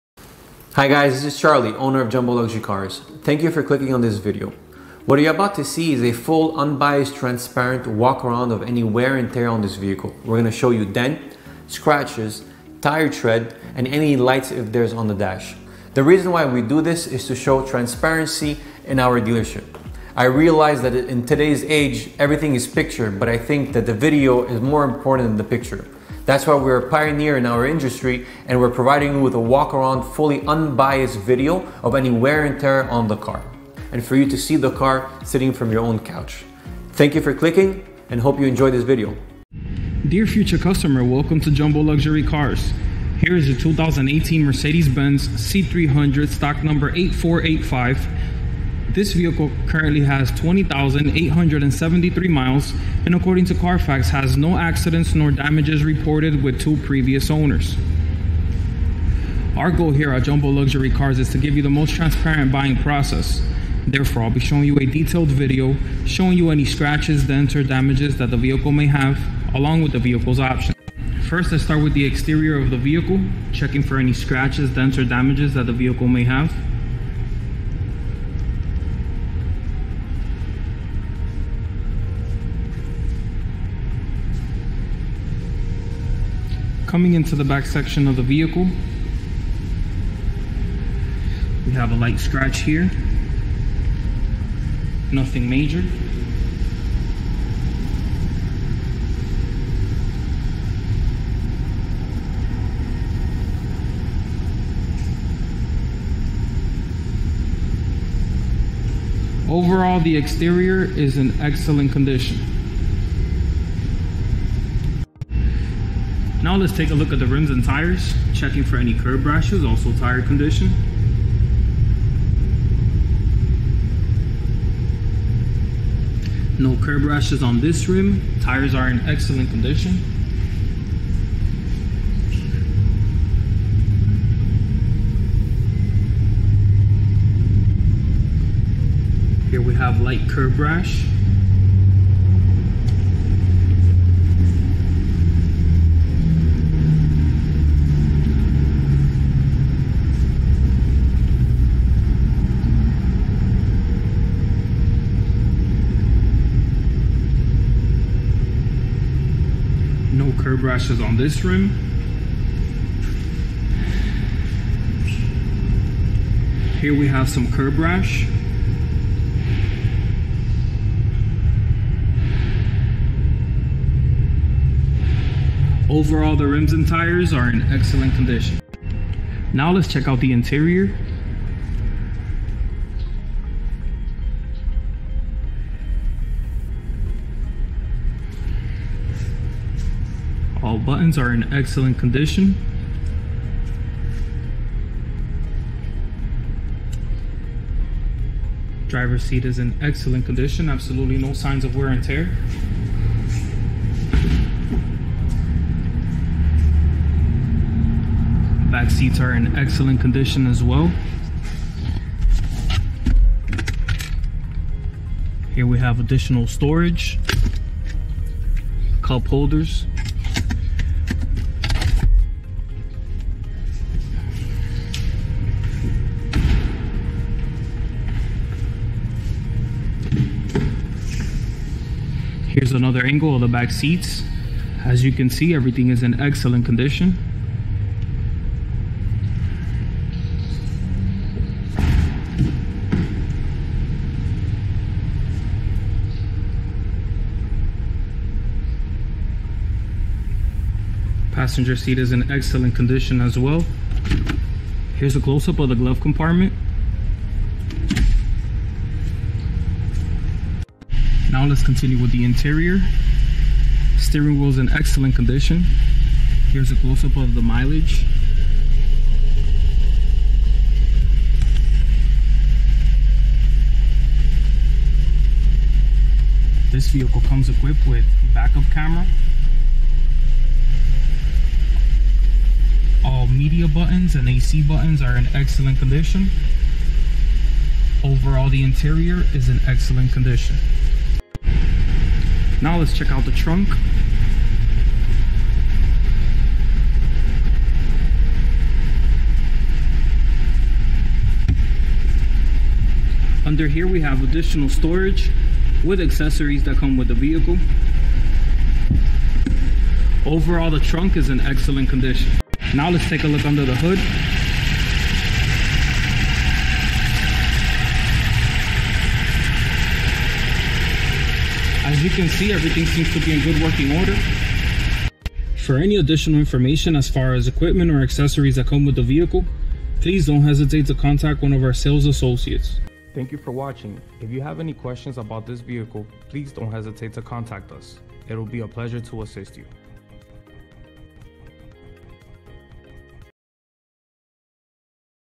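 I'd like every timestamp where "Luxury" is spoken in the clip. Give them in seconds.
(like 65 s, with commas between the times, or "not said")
2 s, 41 s, 60 s.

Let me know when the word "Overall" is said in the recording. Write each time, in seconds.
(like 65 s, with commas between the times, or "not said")
109 s, 175 s, 288 s, 310 s.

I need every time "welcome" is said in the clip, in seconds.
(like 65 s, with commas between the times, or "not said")
41 s.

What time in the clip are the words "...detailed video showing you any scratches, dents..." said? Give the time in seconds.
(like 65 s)
64 s.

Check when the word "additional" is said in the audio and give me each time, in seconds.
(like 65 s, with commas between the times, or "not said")
215 s, 304 s, 325 s.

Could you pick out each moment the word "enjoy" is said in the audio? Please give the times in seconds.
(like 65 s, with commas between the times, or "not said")
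38 s.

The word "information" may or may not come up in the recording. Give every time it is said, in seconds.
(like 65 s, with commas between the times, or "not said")
326 s.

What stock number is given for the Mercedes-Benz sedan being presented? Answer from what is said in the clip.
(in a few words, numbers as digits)
8485.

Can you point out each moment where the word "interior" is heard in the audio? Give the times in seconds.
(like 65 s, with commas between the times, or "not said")
180 s, 262 s, 288 s.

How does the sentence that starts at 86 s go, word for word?
Coming into the back section of the vehicle, we have a light scratch here.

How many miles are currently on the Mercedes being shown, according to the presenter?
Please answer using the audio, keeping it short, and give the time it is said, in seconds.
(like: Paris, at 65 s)
20,873, at 50 s.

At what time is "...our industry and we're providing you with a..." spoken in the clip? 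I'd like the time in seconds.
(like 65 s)
27 s.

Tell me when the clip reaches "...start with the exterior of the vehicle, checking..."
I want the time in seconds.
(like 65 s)
71 s.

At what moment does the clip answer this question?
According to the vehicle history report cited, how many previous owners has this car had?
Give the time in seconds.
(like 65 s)
56 s.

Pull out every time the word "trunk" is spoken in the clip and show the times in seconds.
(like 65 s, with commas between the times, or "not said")
293 s, 310 s.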